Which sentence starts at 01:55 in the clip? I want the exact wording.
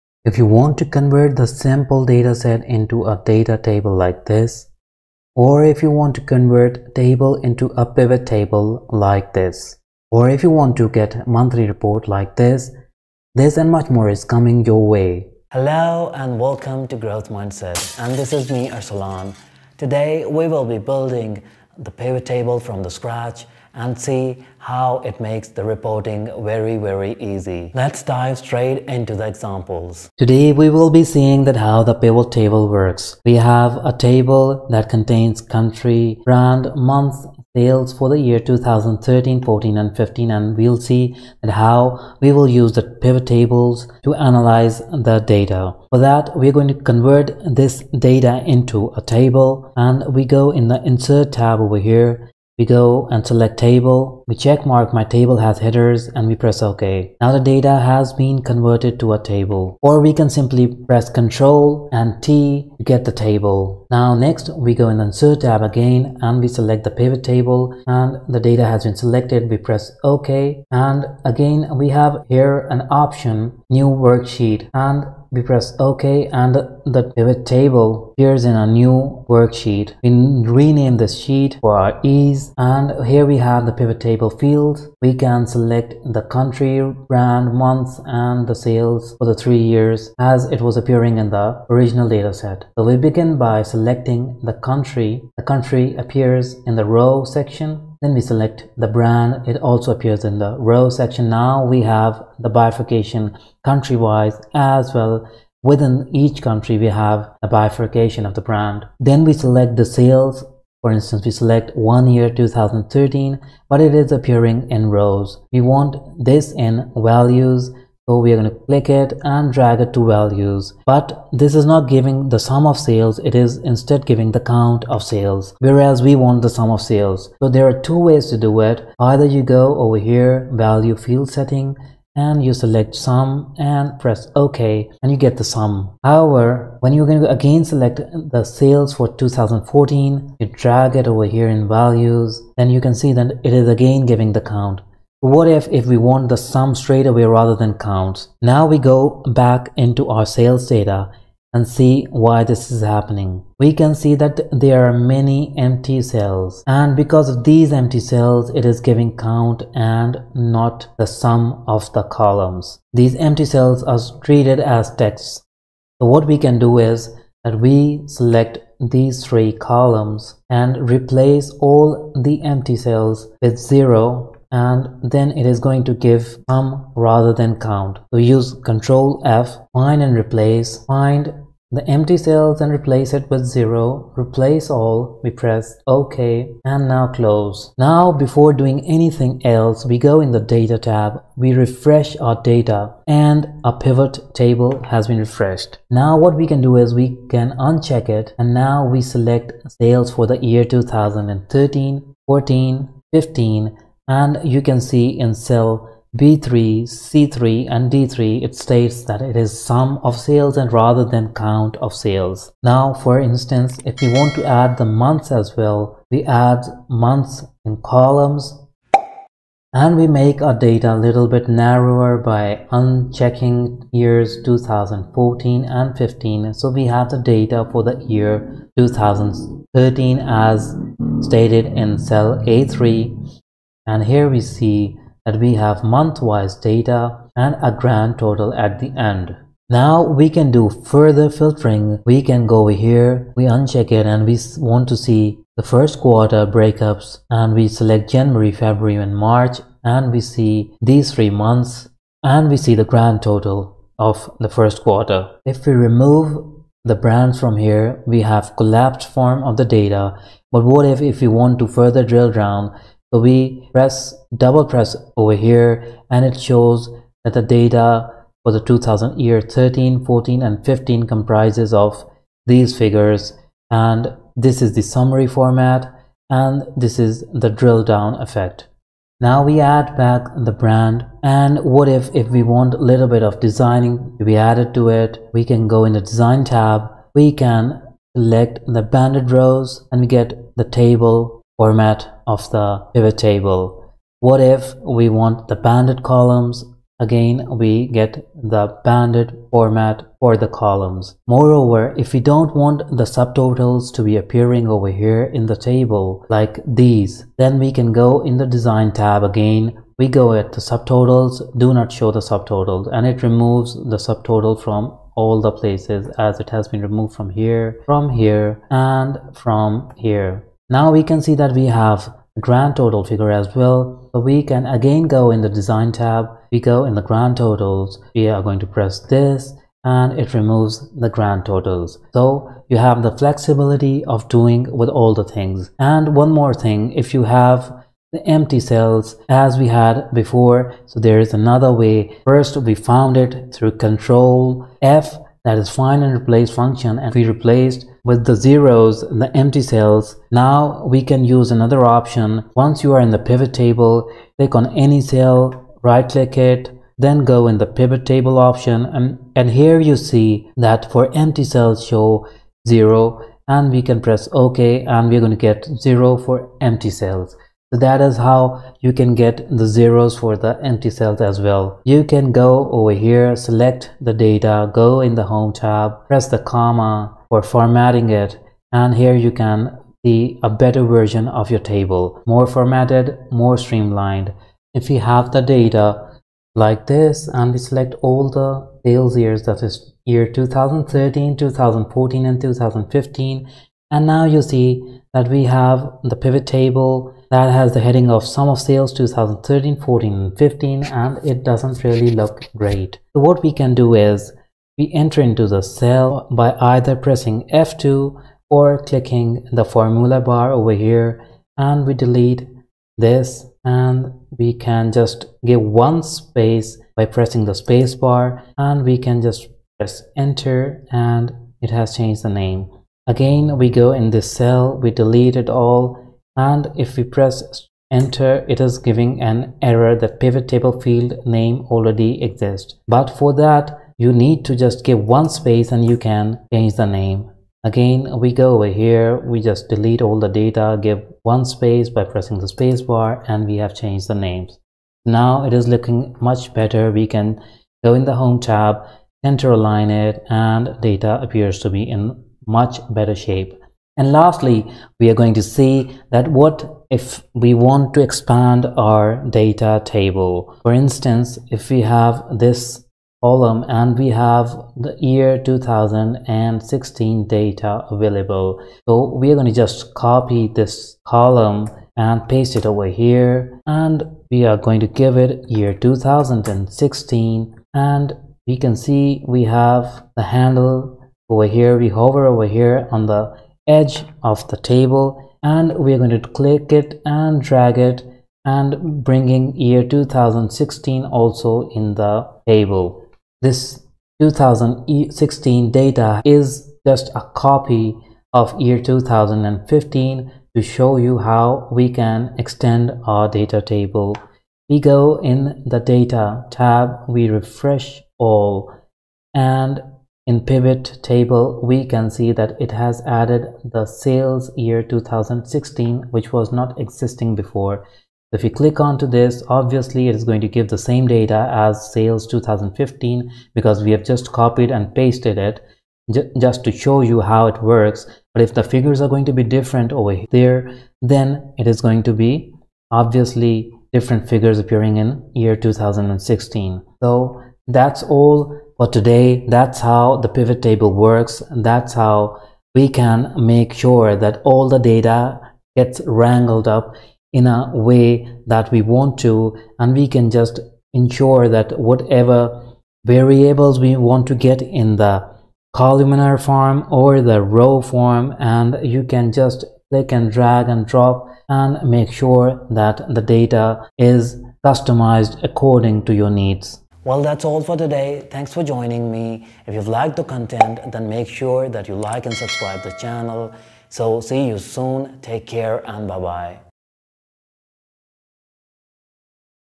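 We want this in values so we are going to click it and drag it to values.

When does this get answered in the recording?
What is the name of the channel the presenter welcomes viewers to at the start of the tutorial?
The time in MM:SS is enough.
00:16.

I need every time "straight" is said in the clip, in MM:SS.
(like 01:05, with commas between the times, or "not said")
00:28, 02:26.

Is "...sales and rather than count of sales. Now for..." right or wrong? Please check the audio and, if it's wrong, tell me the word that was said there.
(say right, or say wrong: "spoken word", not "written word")
right.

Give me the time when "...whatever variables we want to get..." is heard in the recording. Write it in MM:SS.
09:11.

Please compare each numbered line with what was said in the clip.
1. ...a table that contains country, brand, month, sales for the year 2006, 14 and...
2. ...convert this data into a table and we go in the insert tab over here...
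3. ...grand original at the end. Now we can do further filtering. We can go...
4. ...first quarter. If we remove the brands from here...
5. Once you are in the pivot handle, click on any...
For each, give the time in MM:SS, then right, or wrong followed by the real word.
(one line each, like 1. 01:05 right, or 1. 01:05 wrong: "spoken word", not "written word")
1. 00:33 wrong: "2013", not "2006"
2. 00:46 right
3. 03:57 wrong: "total", not "original"
4. 04:14 right
5. 05:52 wrong: "table", not "handle".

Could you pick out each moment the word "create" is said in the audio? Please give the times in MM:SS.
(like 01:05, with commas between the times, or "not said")
not said.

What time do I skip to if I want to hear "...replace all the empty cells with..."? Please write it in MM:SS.
02:50.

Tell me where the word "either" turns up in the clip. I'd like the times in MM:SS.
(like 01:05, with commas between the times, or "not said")
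02:08, 06:46.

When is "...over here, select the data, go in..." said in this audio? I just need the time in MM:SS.
06:12.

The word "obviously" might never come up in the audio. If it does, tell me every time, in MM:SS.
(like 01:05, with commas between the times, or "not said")
08:39, 08:52.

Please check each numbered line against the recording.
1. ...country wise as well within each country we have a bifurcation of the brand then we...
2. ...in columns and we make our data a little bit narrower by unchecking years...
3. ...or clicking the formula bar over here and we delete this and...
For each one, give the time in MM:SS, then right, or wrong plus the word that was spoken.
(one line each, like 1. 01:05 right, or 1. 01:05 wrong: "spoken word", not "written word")
1. 01:43 right
2. 03:37 right
3. 06:48 right.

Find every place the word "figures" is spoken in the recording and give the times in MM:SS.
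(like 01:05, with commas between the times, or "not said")
04:32, 05:23, 08:48, 08:54.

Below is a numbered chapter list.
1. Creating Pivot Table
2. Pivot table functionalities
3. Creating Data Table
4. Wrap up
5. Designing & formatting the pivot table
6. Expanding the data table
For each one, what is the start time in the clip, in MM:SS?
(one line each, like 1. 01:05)
1. 01:04
2. 02:30
3. 00:30
4. 09:26
5. 04:40
6. 07:35.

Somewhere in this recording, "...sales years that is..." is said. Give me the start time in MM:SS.
06:28.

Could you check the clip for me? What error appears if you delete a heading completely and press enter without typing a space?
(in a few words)
Pivot table field name already exists.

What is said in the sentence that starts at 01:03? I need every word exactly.
Now next we go in the insert tab again and we select the pivot table and the data has been selected.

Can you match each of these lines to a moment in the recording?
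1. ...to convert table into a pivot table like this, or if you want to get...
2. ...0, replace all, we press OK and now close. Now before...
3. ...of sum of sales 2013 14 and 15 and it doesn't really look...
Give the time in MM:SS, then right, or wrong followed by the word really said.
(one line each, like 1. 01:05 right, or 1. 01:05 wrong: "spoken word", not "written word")
1. 00:06 right
2. 03:03 right
3. 06:38 right.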